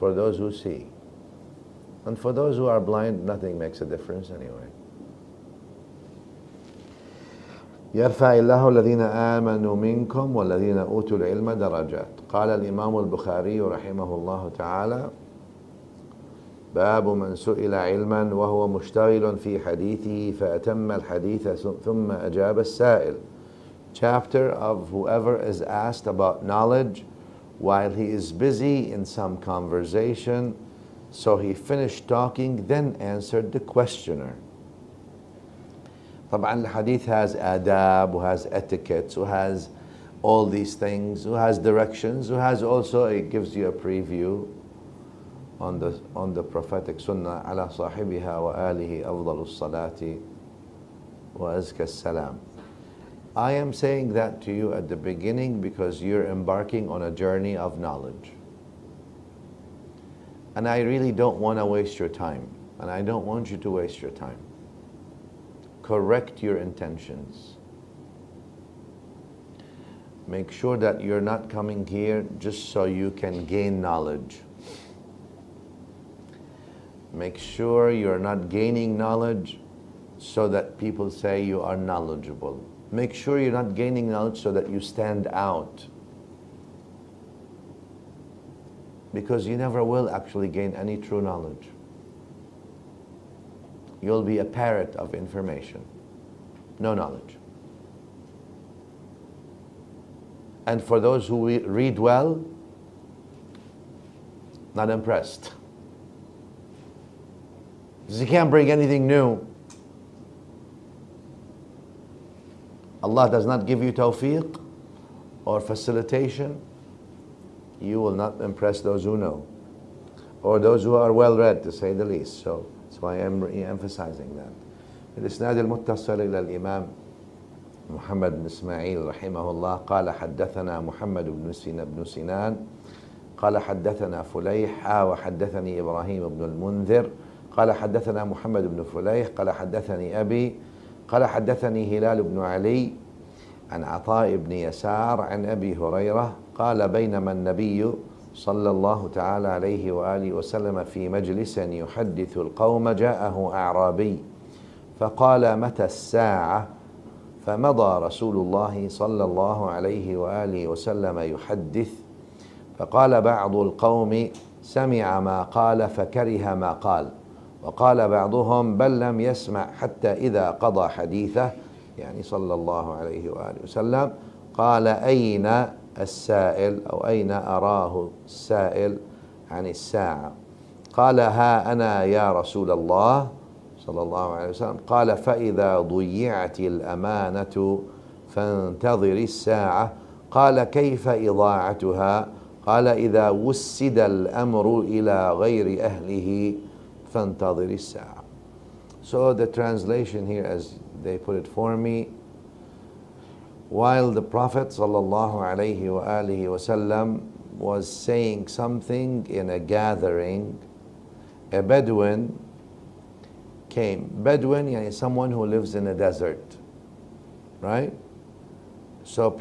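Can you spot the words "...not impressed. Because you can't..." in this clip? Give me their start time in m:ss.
1:44.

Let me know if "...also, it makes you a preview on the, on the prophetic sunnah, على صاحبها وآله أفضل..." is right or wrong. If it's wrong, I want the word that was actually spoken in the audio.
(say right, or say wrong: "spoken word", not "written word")
wrong: "gives", not "makes".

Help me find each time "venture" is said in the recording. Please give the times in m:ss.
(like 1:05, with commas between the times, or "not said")
not said.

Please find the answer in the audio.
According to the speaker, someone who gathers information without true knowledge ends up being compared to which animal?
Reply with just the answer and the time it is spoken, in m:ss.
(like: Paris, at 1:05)
A parrot, at 1:34.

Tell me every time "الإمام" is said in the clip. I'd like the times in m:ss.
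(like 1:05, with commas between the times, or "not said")
0:12, 2:06.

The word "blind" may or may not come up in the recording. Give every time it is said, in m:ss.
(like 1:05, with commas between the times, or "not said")
0:02.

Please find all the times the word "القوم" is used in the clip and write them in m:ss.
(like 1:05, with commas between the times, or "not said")
2:32, 2:43.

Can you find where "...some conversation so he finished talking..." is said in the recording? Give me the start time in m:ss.
0:29.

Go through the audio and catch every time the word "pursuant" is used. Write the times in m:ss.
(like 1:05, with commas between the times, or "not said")
not said.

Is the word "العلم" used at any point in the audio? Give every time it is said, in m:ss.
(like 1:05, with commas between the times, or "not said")
0:11.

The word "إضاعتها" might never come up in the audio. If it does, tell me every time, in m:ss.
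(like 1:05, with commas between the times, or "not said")
3:11.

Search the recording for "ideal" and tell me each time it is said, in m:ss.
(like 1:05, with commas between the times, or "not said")
not said.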